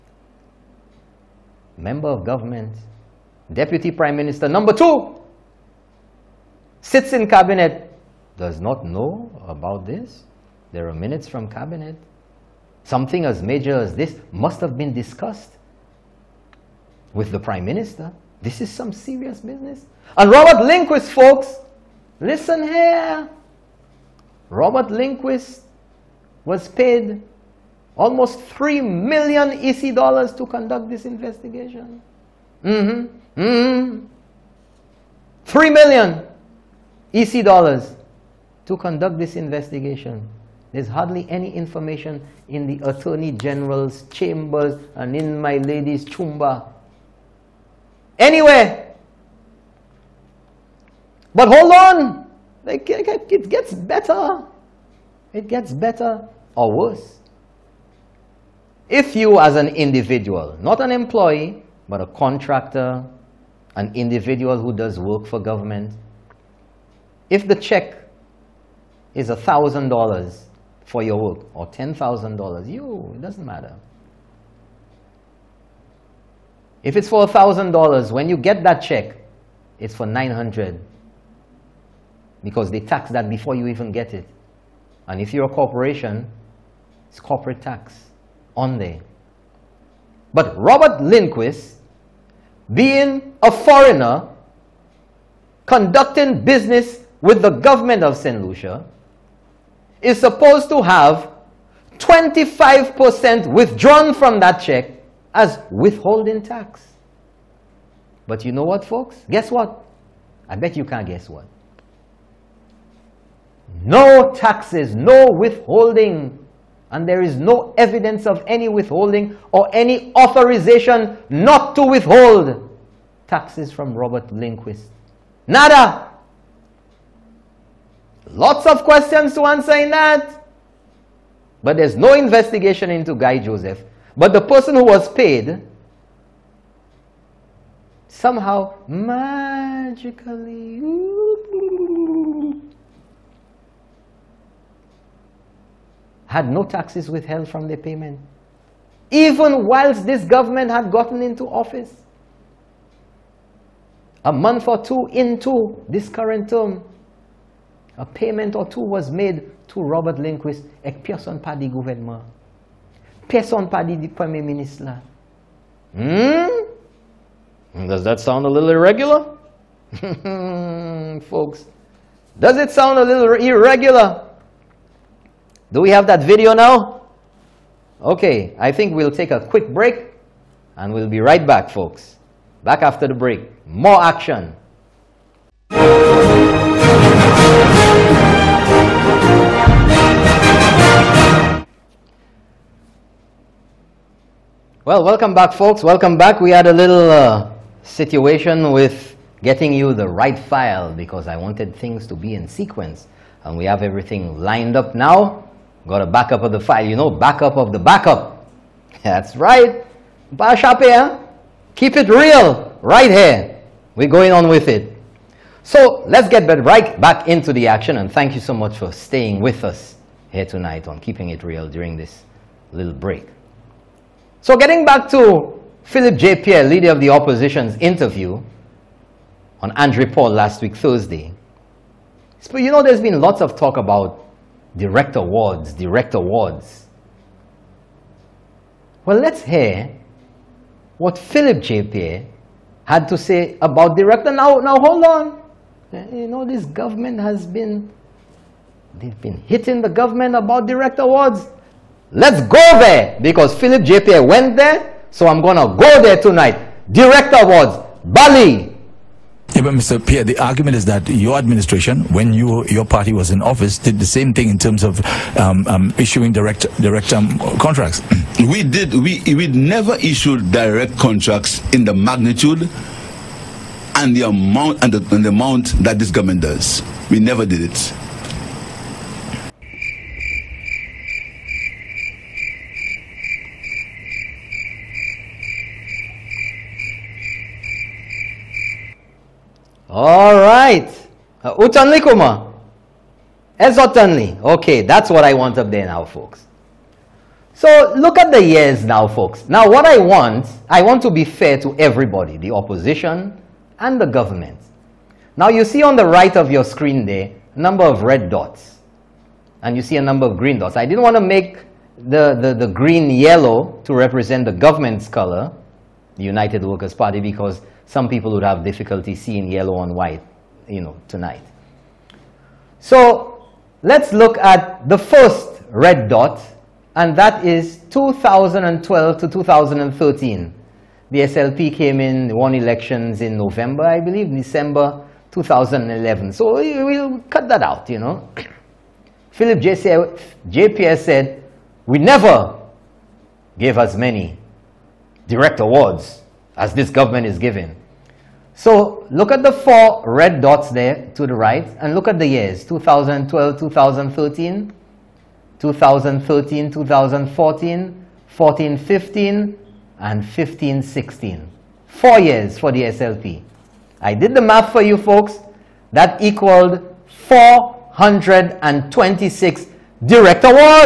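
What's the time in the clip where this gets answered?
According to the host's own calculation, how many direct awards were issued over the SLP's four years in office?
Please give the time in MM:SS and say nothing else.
06:07.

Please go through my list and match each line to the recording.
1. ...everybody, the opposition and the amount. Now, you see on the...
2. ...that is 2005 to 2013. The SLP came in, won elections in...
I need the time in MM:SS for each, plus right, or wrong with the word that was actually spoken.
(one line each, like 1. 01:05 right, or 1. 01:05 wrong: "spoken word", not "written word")
1. 05:01 wrong: "government", not "amount"
2. 05:27 wrong: "2012", not "2005".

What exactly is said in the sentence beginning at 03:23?
And we have everything lined up now.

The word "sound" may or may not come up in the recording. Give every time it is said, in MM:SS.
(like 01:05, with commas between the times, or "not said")
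02:48, 02:52.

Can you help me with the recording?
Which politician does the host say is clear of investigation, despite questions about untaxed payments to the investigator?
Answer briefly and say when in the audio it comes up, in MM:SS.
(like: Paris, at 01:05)
Guy Joseph, at 02:13.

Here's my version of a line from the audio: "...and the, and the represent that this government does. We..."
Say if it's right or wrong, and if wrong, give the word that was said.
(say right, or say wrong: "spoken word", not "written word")
wrong: "amount", not "represent".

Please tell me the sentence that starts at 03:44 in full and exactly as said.
So getting back to Philip J.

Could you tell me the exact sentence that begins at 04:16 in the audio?
Direct awards, Bali, yeah, but Mr.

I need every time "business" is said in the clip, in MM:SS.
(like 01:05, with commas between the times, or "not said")
00:19, 01:36.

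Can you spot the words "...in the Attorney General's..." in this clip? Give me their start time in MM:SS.
00:42.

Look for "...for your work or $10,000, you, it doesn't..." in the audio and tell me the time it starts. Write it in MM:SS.
01:10.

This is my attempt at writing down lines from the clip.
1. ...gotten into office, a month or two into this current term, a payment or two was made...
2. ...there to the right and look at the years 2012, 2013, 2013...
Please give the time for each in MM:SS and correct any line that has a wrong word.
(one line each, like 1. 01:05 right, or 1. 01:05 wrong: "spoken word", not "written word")
1. 02:30 right
2. 05:50 right.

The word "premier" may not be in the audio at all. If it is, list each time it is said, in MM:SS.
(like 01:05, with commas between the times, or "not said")
02:44.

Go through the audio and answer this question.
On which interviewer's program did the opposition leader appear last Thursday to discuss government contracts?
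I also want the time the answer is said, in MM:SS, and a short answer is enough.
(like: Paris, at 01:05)
Andre Paul, at 03:49.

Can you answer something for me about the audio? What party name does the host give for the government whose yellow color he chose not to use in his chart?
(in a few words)
United Workers' Party.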